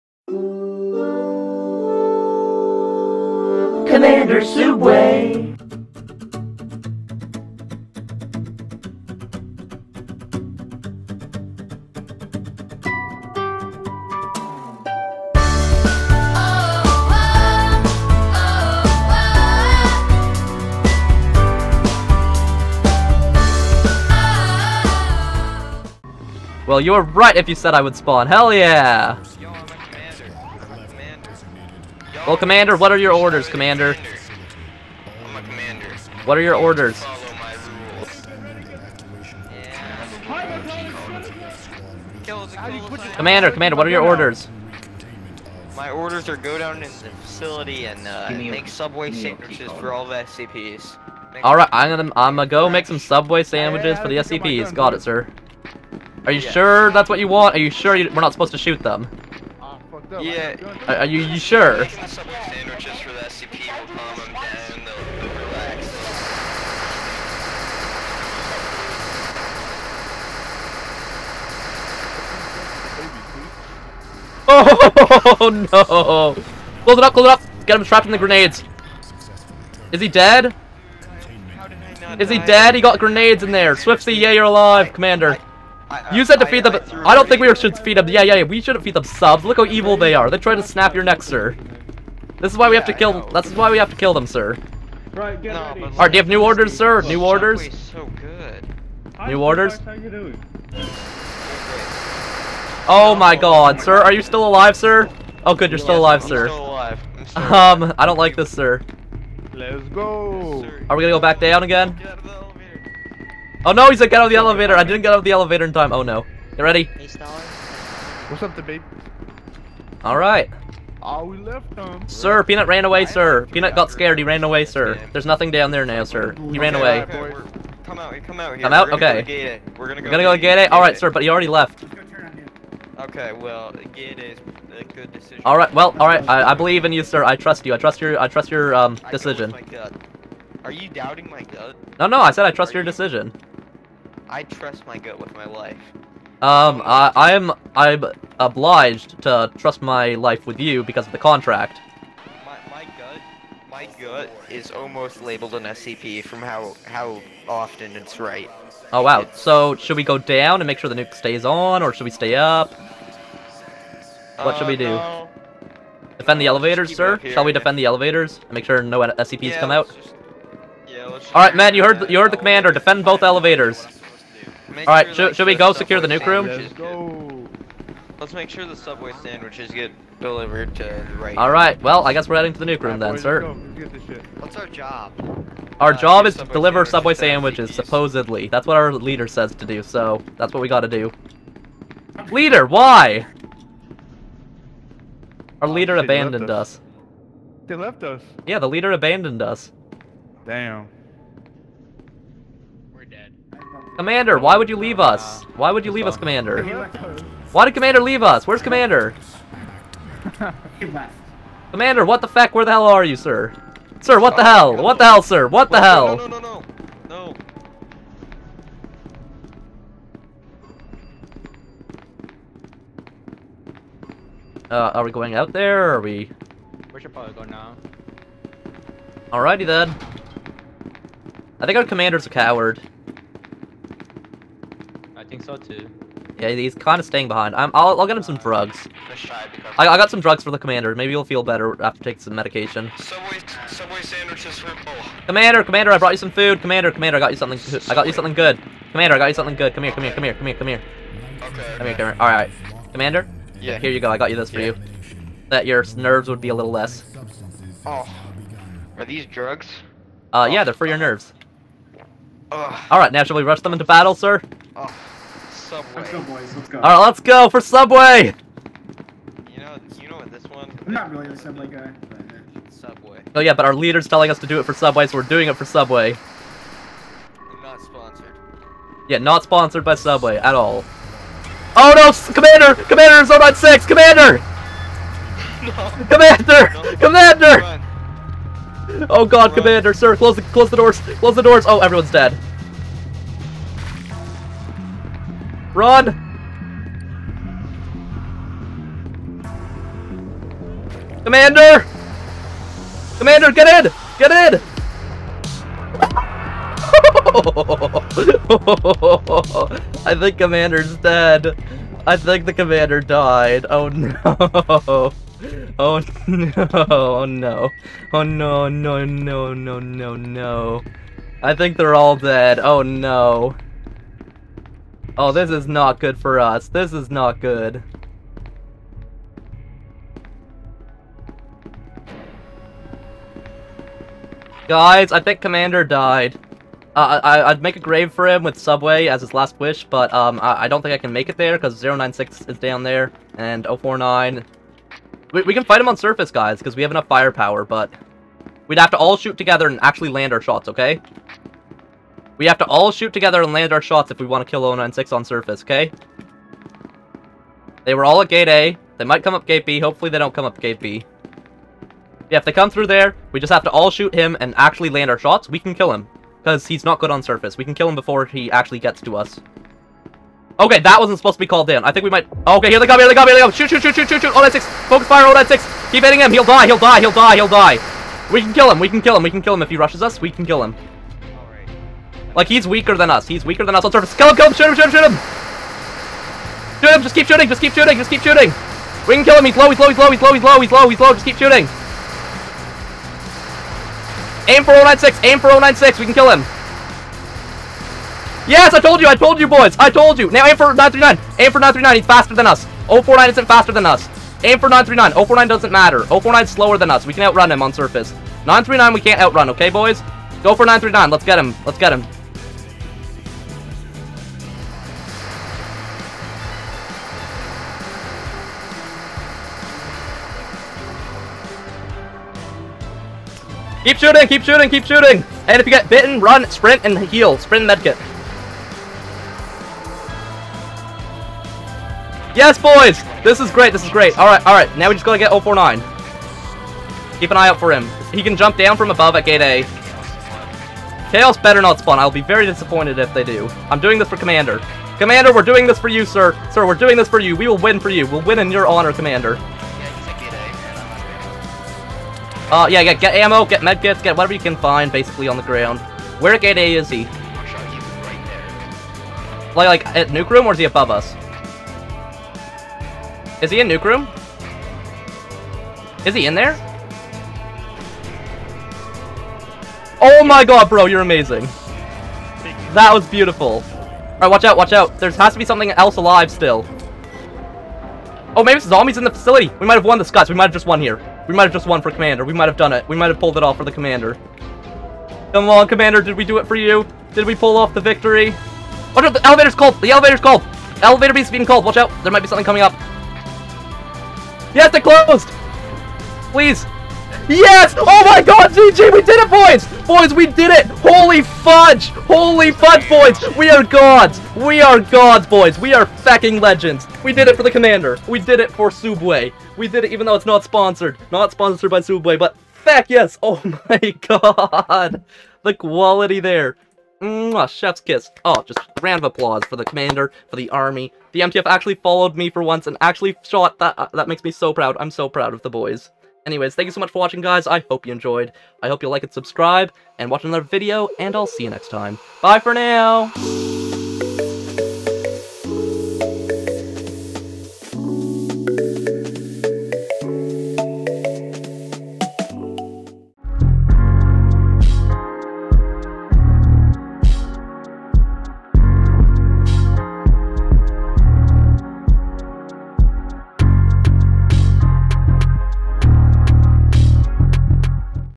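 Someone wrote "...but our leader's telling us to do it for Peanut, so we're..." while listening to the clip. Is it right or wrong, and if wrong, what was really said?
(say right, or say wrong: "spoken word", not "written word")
wrong: "Subway", not "Peanut".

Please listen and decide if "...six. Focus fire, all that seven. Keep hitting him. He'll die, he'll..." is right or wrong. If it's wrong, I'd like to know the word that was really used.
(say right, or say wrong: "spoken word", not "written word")
wrong: "six", not "seven".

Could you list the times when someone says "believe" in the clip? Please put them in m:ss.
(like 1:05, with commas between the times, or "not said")
2:16.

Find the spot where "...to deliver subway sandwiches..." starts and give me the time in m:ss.
3:06.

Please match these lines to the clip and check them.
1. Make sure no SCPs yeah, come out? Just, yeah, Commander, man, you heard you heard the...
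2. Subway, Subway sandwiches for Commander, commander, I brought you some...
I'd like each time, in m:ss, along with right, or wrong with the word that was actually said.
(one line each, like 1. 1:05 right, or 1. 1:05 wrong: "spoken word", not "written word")
1. 2:48 wrong: "Alright", not "Commander"
2. 4:02 right.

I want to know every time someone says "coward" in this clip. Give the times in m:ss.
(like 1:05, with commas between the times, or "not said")
3:52.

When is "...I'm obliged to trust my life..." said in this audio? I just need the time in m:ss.
2:27.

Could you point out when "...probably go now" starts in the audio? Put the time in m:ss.
3:47.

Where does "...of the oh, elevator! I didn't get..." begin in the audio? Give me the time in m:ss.
1:54.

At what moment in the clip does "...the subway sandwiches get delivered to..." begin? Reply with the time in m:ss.
2:58.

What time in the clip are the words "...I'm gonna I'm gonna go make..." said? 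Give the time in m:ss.
0:51.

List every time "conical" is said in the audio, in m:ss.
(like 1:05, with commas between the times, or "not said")
not said.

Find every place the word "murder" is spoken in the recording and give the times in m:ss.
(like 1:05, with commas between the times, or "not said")
not said.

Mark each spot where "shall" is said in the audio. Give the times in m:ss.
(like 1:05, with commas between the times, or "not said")
2:47, 4:23.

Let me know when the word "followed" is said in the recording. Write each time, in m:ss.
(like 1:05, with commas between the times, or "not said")
8:41.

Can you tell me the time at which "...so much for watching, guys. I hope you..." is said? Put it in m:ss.
8:46.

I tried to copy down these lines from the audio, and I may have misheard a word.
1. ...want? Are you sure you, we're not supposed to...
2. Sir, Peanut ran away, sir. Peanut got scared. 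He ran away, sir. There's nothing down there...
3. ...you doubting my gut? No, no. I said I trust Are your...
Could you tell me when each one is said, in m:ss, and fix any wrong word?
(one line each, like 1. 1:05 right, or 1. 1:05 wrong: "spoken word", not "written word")
1. 0:57 right
2. 2:02 right
3. 2:20 right.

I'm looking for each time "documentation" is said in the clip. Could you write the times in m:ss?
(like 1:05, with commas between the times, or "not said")
not said.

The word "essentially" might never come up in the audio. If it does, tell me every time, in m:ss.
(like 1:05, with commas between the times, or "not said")
not said.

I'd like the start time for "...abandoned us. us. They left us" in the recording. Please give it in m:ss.
3:15.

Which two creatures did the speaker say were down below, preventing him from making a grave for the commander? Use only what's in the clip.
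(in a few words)
096 and 049.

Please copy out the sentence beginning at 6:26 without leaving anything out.
Shoot him, just keep shooting, just keep shooting, just keep shooting.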